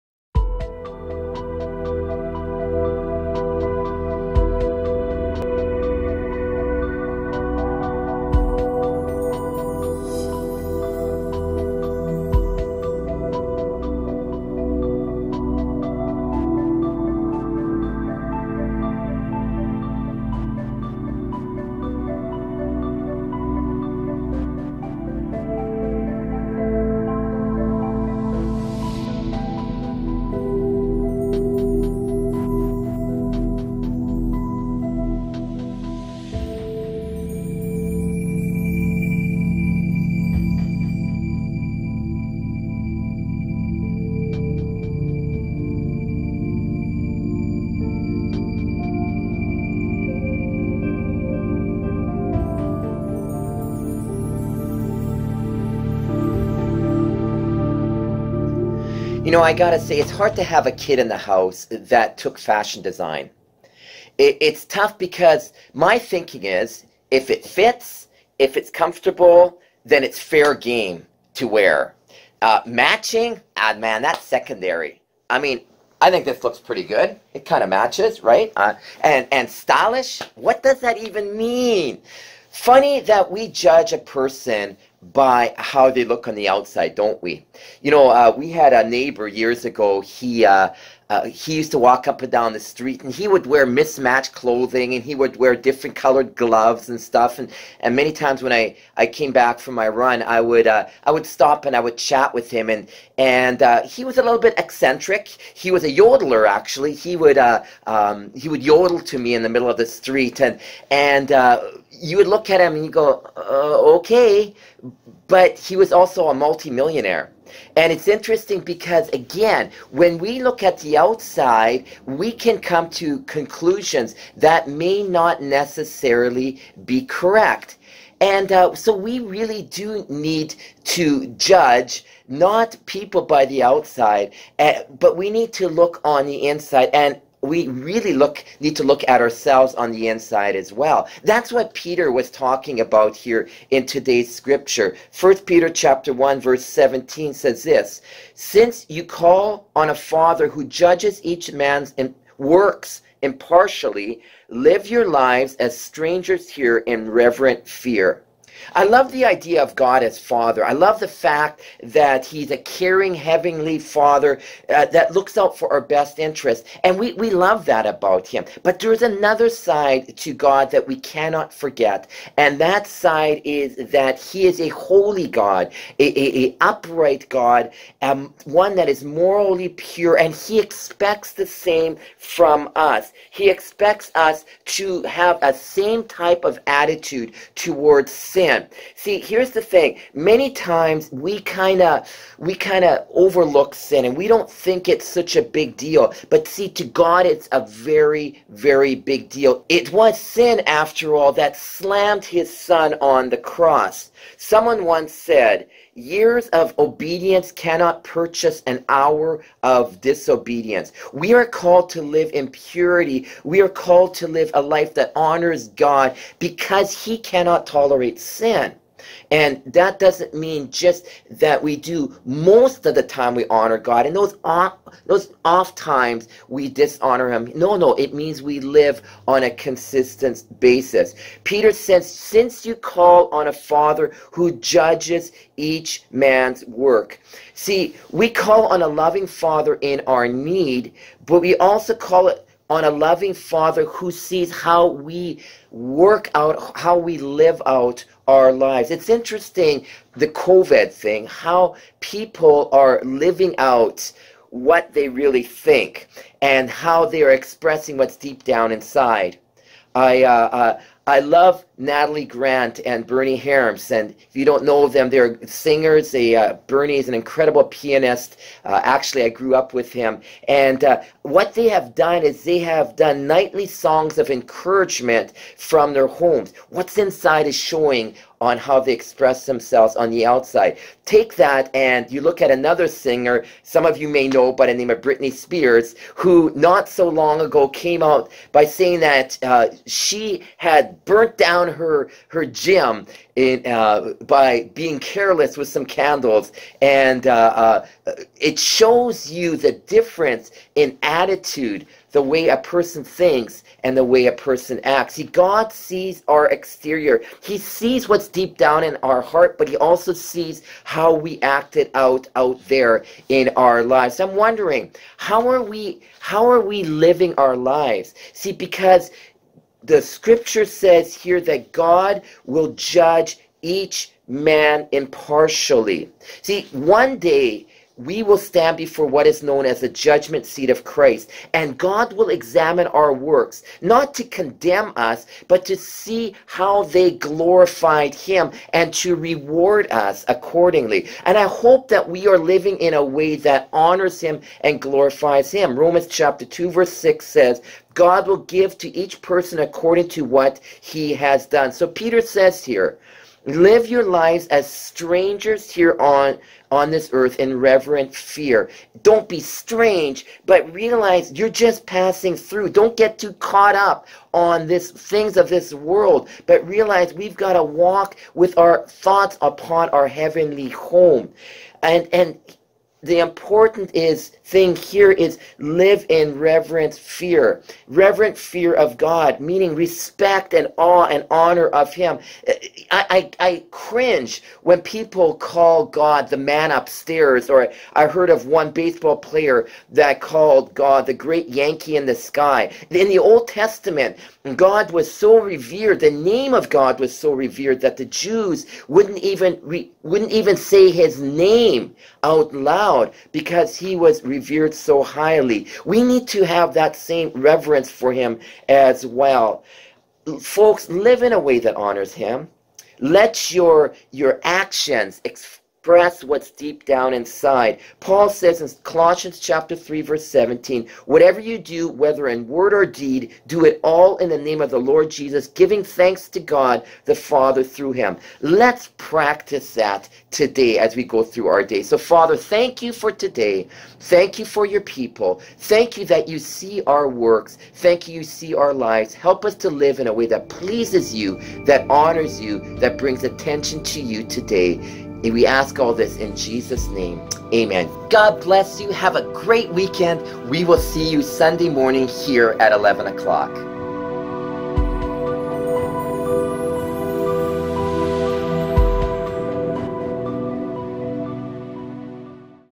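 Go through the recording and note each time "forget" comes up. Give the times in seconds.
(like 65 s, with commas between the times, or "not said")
171 s.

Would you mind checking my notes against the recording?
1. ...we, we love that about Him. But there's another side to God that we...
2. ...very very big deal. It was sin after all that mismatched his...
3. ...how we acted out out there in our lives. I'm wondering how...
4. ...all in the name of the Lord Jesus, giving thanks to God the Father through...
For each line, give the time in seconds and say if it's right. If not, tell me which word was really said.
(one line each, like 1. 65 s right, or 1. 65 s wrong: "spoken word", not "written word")
1. 166 s right
2. 197 s wrong: "slammed", not "mismatched"
3. 310 s right
4. 423 s right.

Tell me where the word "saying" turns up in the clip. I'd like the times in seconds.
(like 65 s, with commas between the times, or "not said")
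288 s.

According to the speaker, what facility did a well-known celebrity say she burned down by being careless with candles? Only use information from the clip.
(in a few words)
Her gym.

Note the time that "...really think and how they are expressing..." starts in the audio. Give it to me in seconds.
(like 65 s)
255 s.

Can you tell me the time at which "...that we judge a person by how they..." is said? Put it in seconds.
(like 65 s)
83 s.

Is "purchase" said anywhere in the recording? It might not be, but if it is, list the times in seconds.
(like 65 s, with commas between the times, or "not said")
208 s.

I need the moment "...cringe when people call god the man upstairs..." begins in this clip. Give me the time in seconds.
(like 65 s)
383 s.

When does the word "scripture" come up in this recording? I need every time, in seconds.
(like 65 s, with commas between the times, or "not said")
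144 s, 320 s.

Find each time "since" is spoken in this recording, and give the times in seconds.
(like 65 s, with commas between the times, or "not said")
148 s, 232 s.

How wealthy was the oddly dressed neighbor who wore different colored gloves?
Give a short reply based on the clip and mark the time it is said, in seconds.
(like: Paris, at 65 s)
Multimillionaire, at 116 s.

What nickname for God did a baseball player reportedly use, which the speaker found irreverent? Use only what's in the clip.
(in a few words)
The great Yankee in the sky.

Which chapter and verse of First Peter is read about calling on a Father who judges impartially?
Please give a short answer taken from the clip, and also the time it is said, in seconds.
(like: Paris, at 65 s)
Chapter 1 verse 17, at 145 s.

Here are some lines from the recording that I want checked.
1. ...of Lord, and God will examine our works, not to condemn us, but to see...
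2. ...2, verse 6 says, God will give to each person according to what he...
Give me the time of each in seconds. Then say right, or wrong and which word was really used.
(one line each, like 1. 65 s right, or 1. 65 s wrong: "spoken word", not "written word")
1. 330 s wrong: "Christ", not "Lord"
2. 346 s right.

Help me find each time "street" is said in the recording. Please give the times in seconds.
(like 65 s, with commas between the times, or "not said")
92 s, 109 s.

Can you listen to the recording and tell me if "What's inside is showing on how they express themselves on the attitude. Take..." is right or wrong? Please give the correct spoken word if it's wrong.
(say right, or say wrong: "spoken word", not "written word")
wrong: "outside", not "attitude".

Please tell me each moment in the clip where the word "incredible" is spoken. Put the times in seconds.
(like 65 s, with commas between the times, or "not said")
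267 s.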